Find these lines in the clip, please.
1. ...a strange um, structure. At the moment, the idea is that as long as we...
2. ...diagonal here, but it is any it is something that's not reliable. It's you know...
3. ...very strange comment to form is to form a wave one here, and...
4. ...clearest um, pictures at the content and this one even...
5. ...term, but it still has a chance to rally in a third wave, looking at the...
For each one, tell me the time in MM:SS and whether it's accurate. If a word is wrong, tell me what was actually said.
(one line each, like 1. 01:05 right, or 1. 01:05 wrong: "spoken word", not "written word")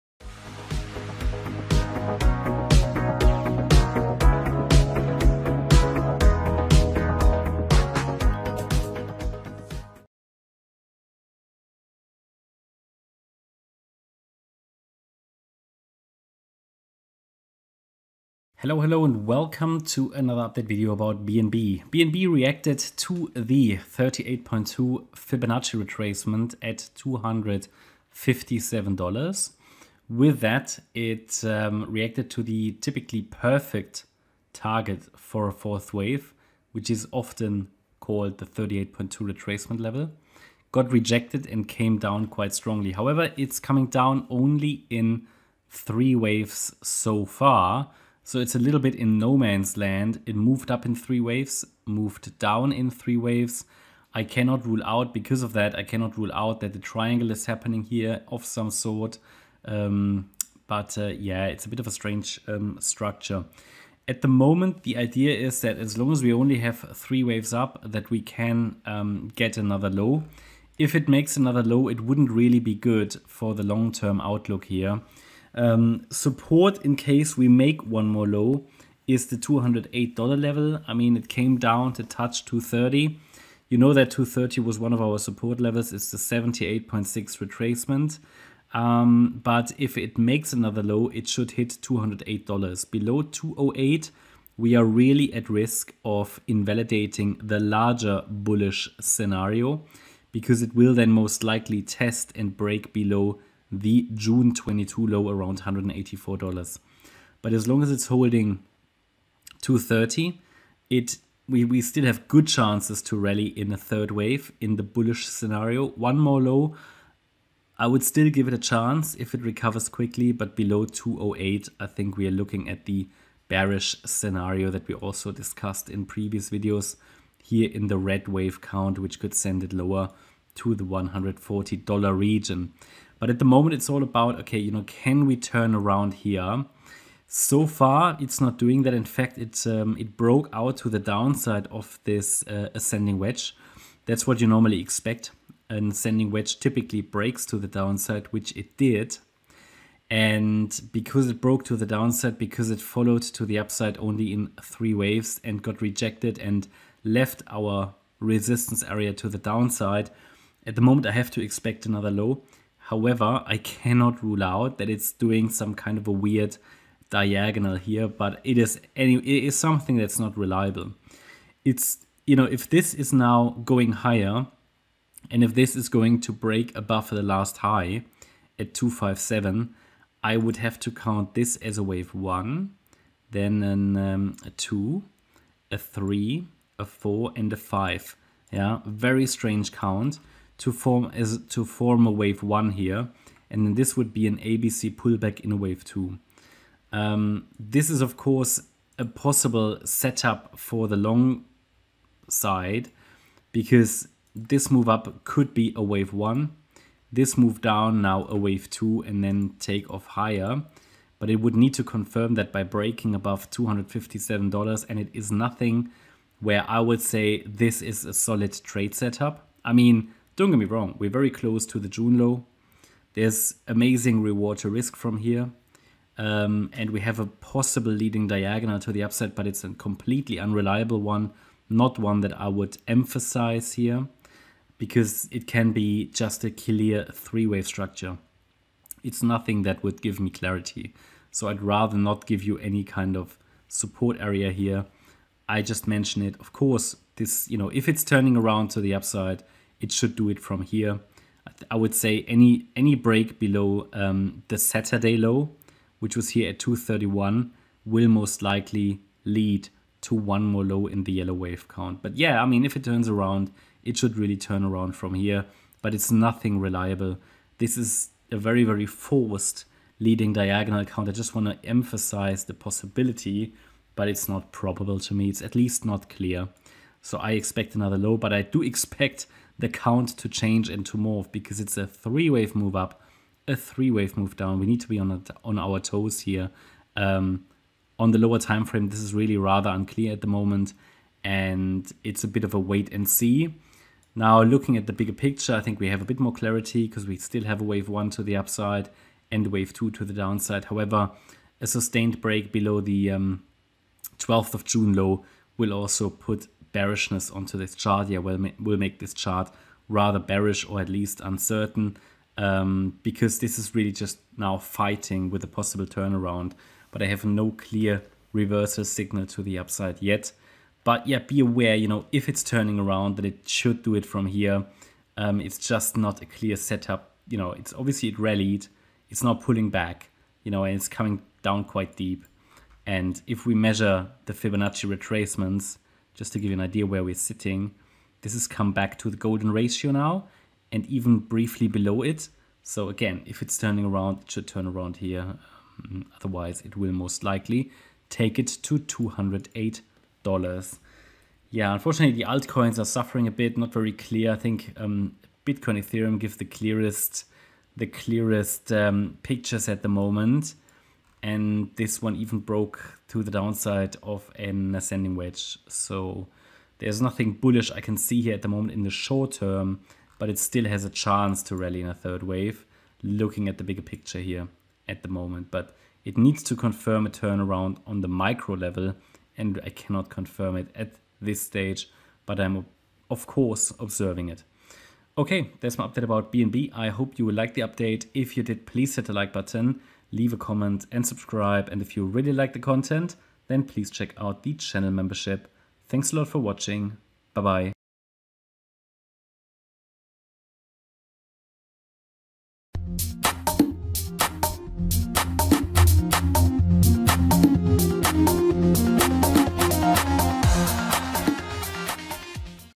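1. 01:01 right
2. 02:47 right
3. 03:08 wrong: "count", not "comment"
4. 05:57 wrong: "moment", not "content"
5. 06:09 right.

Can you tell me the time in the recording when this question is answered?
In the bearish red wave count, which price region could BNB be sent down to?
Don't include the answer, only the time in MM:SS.
02:10.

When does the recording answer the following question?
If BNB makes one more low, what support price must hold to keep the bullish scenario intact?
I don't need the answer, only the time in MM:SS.
01:19.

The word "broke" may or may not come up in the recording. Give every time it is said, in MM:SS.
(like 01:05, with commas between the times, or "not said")
02:20, 02:31, 06:02.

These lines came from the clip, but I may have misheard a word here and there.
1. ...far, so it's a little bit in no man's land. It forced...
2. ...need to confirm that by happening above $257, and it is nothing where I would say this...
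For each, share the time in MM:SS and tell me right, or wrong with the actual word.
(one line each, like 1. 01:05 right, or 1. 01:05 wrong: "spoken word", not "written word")
1. 00:47 wrong: "moved", not "forced"
2. 03:31 wrong: "breaking", not "happening".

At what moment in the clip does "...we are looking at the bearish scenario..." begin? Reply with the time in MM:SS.
02:02.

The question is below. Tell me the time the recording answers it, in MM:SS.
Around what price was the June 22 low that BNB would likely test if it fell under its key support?
01:45.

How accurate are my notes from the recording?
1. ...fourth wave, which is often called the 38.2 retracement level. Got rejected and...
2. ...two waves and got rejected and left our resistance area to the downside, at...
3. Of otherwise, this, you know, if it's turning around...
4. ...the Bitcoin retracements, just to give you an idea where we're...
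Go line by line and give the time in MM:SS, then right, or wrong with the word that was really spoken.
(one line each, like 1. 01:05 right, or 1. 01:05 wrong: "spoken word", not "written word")
1. 00:35 right
2. 02:34 wrong: "three", not "two"
3. 04:06 wrong: "course", not "otherwise"
4. 05:34 wrong: "Fibonacci", not "Bitcoin".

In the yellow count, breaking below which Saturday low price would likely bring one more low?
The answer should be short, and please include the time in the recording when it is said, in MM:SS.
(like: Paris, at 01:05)
231, at 04:16.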